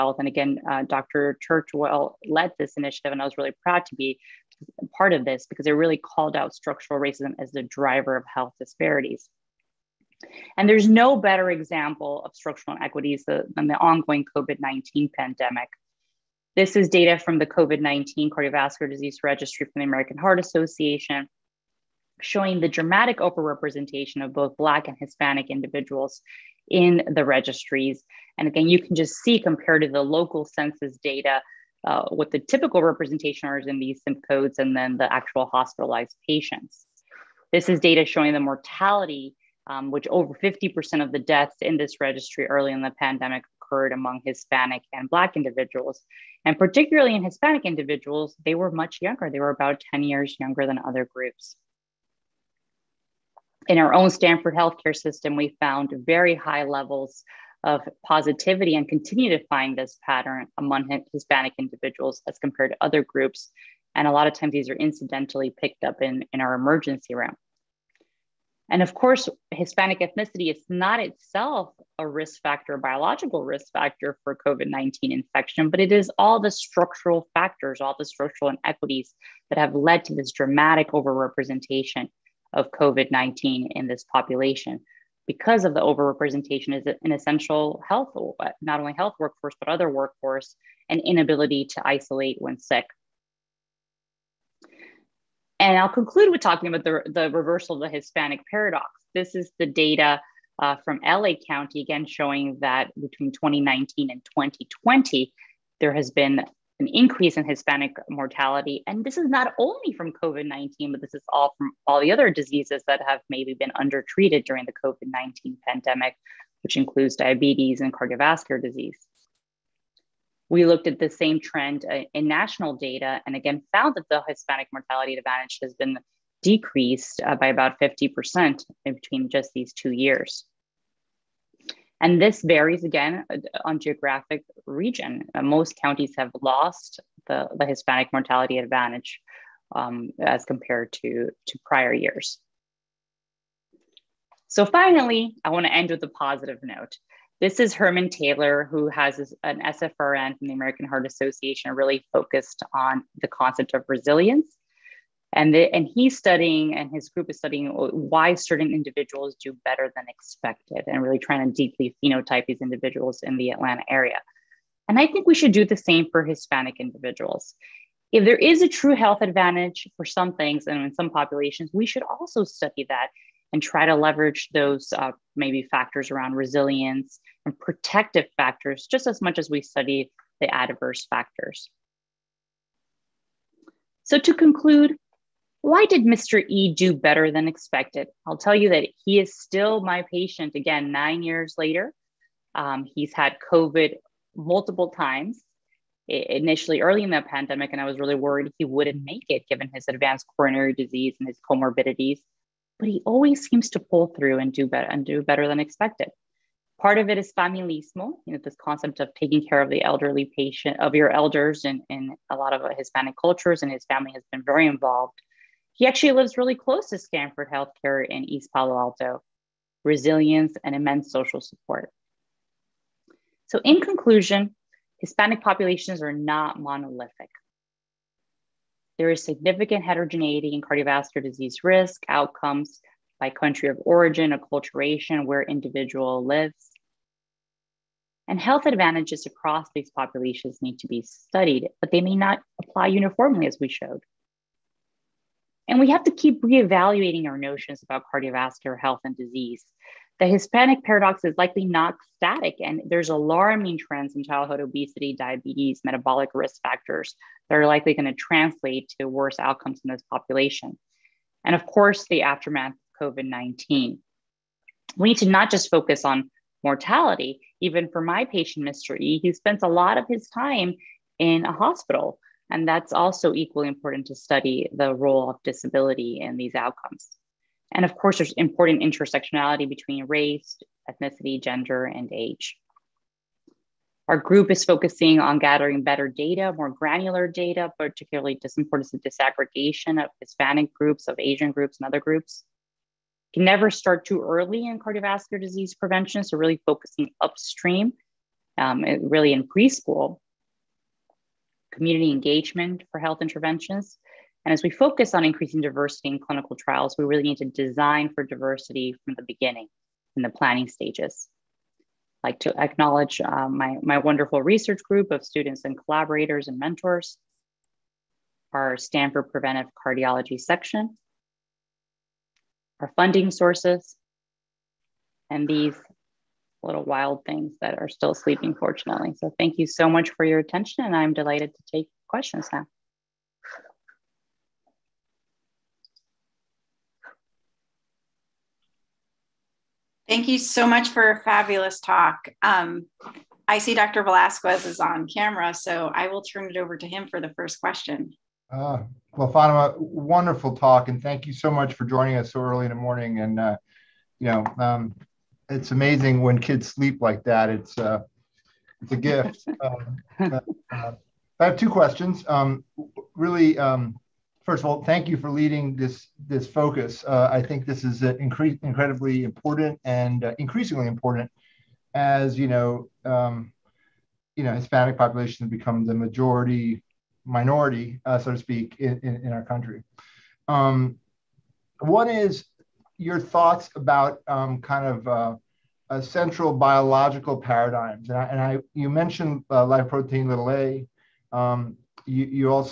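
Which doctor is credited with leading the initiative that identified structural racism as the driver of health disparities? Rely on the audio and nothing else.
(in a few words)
Dr. Churchwell.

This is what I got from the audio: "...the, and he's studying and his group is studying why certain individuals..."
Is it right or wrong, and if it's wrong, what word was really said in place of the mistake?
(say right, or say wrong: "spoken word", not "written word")
right.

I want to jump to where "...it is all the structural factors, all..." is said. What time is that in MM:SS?
01:15.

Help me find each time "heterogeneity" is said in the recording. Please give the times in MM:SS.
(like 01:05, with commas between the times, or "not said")
03:49.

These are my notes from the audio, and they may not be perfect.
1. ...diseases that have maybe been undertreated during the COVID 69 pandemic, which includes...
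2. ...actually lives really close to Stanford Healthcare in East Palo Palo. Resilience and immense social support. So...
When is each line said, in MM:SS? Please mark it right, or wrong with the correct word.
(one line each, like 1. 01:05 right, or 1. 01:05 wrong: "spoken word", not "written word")
1. 01:52 wrong: "19", not "69"
2. 03:35 wrong: "Alto", not "Palo".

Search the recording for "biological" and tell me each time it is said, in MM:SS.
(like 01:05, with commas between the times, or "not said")
01:12, 06:26.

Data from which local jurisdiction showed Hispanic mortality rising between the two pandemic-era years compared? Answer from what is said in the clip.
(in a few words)
LA County.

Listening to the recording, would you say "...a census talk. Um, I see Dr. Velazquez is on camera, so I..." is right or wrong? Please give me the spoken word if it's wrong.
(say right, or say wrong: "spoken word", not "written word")
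wrong: "fabulous", not "census".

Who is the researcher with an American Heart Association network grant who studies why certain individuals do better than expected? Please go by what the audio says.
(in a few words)
Herman Taylor.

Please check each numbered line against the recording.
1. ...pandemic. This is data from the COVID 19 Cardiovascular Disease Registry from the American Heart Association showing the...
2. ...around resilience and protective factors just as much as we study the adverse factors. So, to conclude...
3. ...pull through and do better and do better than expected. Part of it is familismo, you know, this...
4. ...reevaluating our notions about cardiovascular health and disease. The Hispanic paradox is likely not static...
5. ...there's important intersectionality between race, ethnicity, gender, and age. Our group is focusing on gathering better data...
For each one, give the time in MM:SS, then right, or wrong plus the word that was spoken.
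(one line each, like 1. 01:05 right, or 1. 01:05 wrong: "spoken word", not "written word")
1. 00:15 right
2. 02:56 right
3. 03:23 right
4. 04:06 right
5. 04:38 right.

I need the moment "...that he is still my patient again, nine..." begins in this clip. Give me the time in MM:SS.
03:08.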